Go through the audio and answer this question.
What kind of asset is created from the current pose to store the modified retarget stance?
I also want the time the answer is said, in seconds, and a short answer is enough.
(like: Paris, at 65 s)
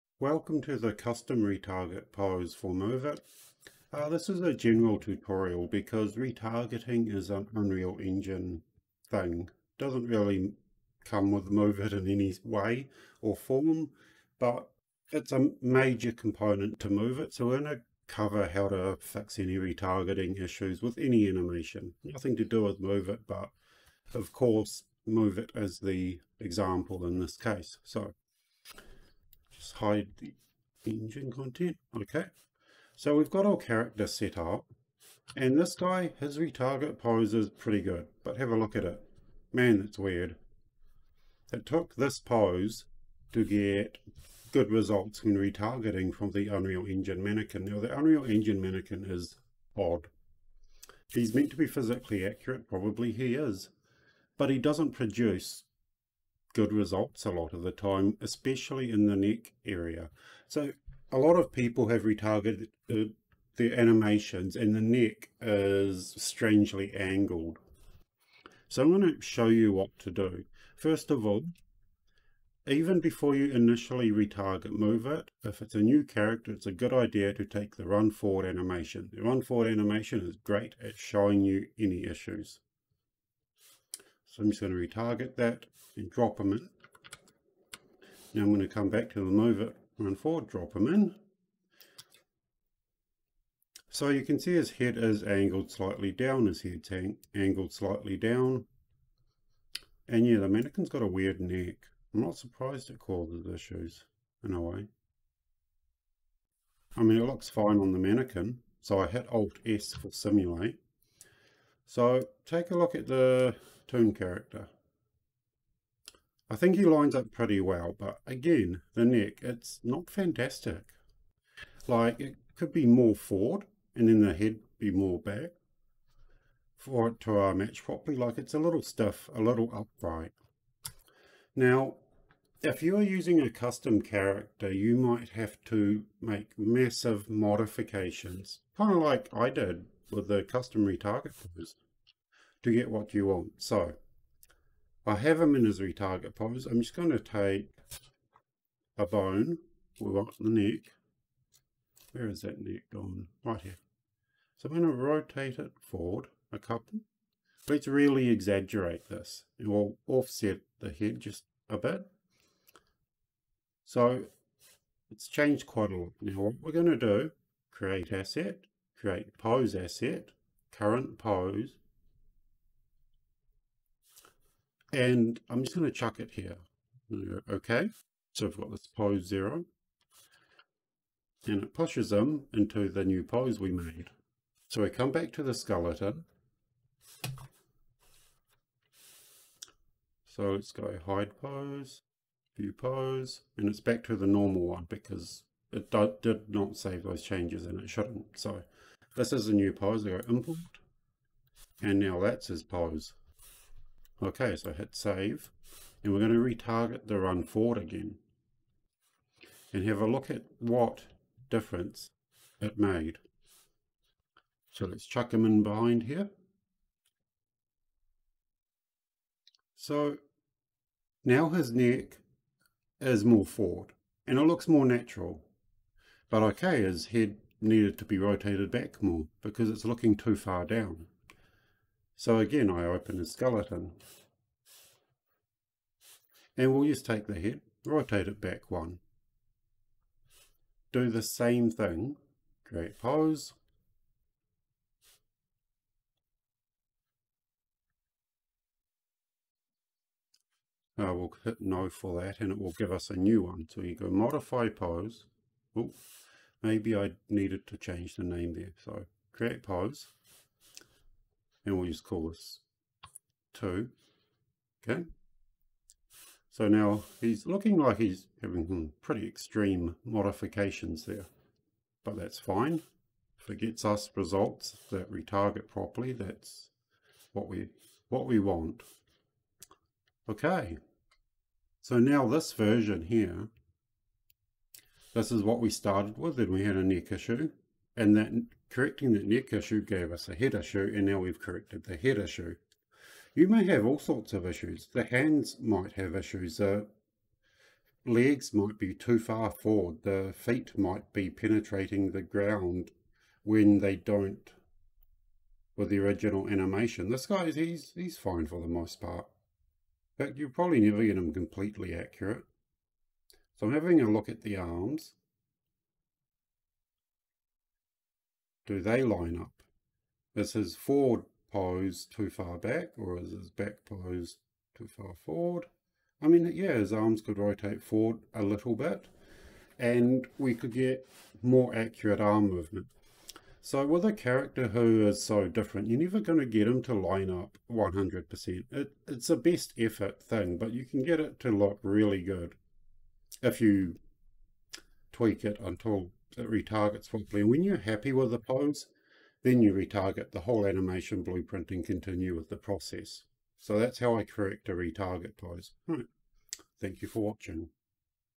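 Pose asset, at 169 s.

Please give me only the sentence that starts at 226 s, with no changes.
But okay, his head needed to be rotated back more because it's looking too far down.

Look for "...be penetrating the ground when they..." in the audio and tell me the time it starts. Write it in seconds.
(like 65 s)
301 s.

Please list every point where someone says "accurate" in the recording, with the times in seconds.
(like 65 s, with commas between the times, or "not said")
52 s, 311 s, 331 s.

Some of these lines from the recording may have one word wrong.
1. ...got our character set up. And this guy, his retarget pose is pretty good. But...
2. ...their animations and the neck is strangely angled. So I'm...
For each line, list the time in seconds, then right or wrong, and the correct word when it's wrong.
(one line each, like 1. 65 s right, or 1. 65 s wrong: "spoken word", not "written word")
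1. 33 s right
2. 63 s right.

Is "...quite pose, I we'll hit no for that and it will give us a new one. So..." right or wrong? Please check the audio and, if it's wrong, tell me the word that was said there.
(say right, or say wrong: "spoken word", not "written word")
wrong: "create", not "quite".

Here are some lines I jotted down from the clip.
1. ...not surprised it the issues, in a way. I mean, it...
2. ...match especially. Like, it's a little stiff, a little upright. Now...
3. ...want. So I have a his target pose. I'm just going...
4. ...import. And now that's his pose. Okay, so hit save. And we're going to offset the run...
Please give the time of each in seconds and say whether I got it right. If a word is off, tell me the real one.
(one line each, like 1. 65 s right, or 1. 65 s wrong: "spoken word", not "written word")
1. 102 s right
2. 127 s wrong: "properly", not "especially"
3. 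143 s right
4. 200 s wrong: "retarget", not "offset".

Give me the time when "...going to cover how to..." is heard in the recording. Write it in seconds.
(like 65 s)
17 s.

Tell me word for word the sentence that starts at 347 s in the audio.
When you're happy with the pose, then you retarget the whole animation blueprint and continue with the process.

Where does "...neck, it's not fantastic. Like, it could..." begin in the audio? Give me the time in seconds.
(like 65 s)
119 s.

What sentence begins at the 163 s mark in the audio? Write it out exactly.
So it's changed quite a lot.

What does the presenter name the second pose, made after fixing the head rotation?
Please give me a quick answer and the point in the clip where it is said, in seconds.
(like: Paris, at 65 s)
2, at 263 s.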